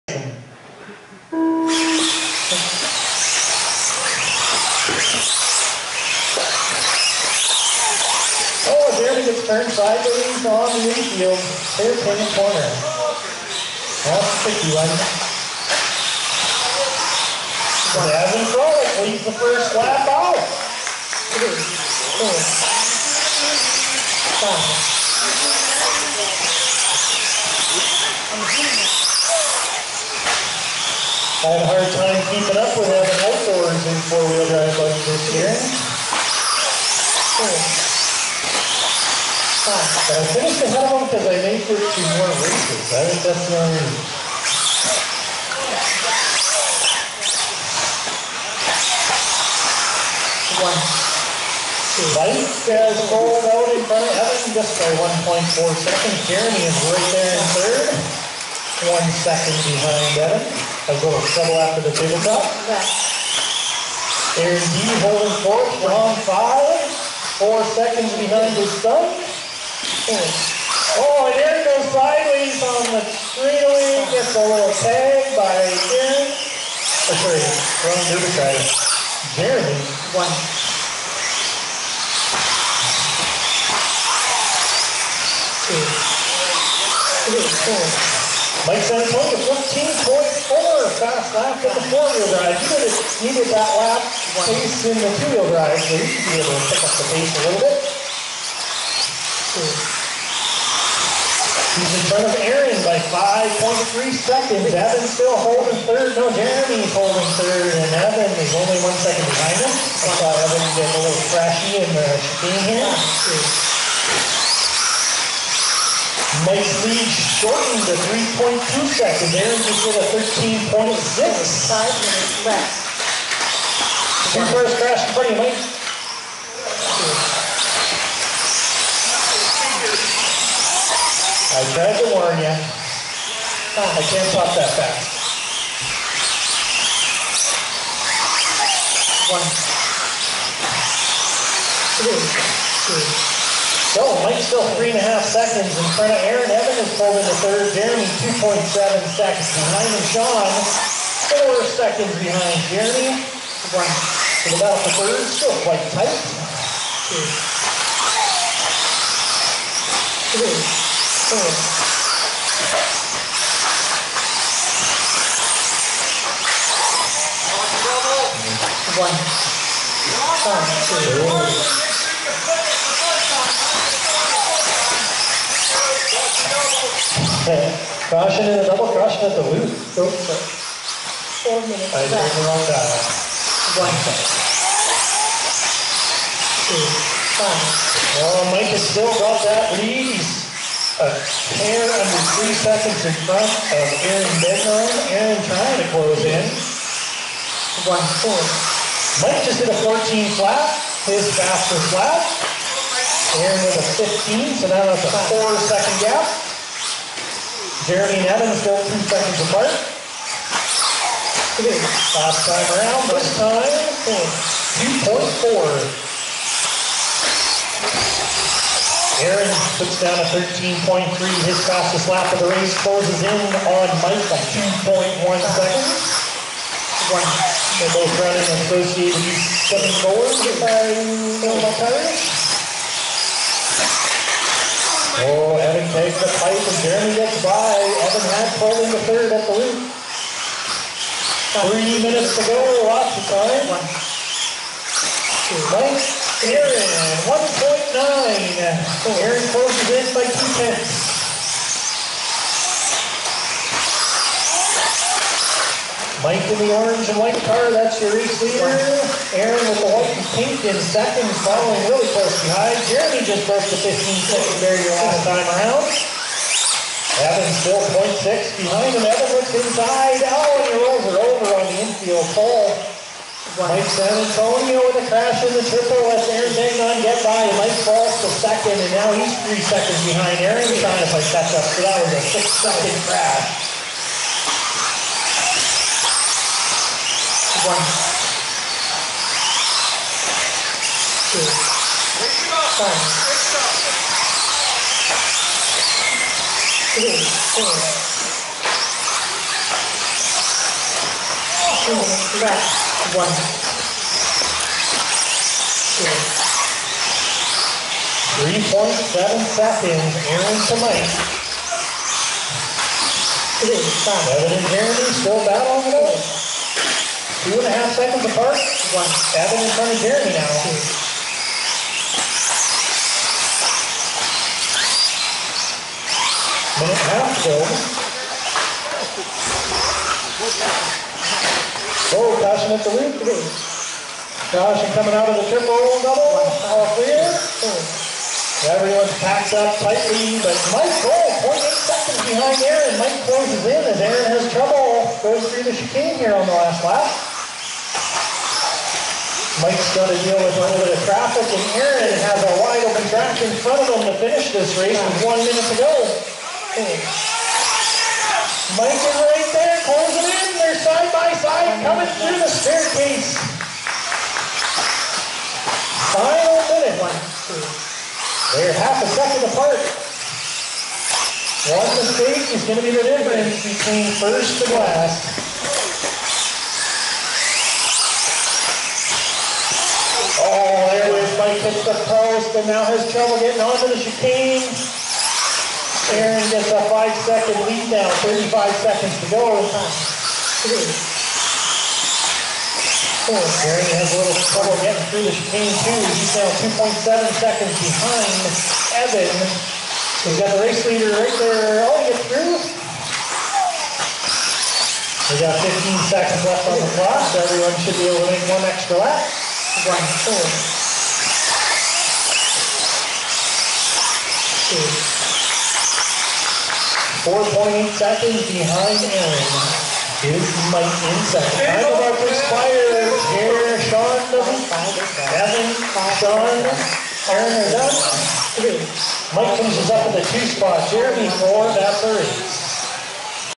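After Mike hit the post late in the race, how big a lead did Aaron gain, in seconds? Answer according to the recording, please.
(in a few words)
5 seconds.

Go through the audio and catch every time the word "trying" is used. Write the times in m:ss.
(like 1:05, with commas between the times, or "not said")
3:15, 4:40.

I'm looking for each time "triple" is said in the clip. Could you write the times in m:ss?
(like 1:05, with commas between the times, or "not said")
4:35, 5:35.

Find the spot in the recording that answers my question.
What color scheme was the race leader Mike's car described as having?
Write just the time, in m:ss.
4:16.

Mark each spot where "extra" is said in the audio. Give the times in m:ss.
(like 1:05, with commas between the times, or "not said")
6:48.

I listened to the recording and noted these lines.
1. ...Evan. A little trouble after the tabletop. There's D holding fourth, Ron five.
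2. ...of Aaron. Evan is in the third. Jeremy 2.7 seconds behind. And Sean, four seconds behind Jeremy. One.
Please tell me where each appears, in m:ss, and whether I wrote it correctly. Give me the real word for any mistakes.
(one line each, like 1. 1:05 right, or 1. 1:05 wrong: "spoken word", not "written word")
1. 1:00 right
2. 2:26 right.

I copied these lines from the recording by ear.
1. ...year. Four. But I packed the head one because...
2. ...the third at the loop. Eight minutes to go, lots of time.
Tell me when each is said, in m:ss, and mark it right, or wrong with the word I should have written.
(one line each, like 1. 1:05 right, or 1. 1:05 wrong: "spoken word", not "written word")
1. 0:35 wrong: "finished", not "packed"
2. 3:58 wrong: "Three", not "Eight".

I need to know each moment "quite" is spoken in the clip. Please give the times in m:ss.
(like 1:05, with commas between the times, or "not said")
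2:35.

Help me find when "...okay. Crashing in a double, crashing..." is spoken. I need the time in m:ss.
2:57.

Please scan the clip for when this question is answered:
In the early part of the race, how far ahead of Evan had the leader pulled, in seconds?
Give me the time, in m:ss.
0:55.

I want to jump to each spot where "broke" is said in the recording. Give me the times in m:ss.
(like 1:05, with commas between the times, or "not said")
4:23.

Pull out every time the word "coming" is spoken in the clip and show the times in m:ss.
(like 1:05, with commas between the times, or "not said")
5:34, 6:01.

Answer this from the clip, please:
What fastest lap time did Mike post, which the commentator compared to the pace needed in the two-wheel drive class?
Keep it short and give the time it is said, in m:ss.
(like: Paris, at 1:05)
14.4, at 1:29.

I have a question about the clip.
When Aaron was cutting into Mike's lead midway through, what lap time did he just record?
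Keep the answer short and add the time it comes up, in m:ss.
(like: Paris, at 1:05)
13.6, at 2:00.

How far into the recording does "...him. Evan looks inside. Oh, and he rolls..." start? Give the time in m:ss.
4:28.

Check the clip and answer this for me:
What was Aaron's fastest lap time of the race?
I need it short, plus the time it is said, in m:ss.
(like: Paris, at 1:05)
13.3, at 3:40.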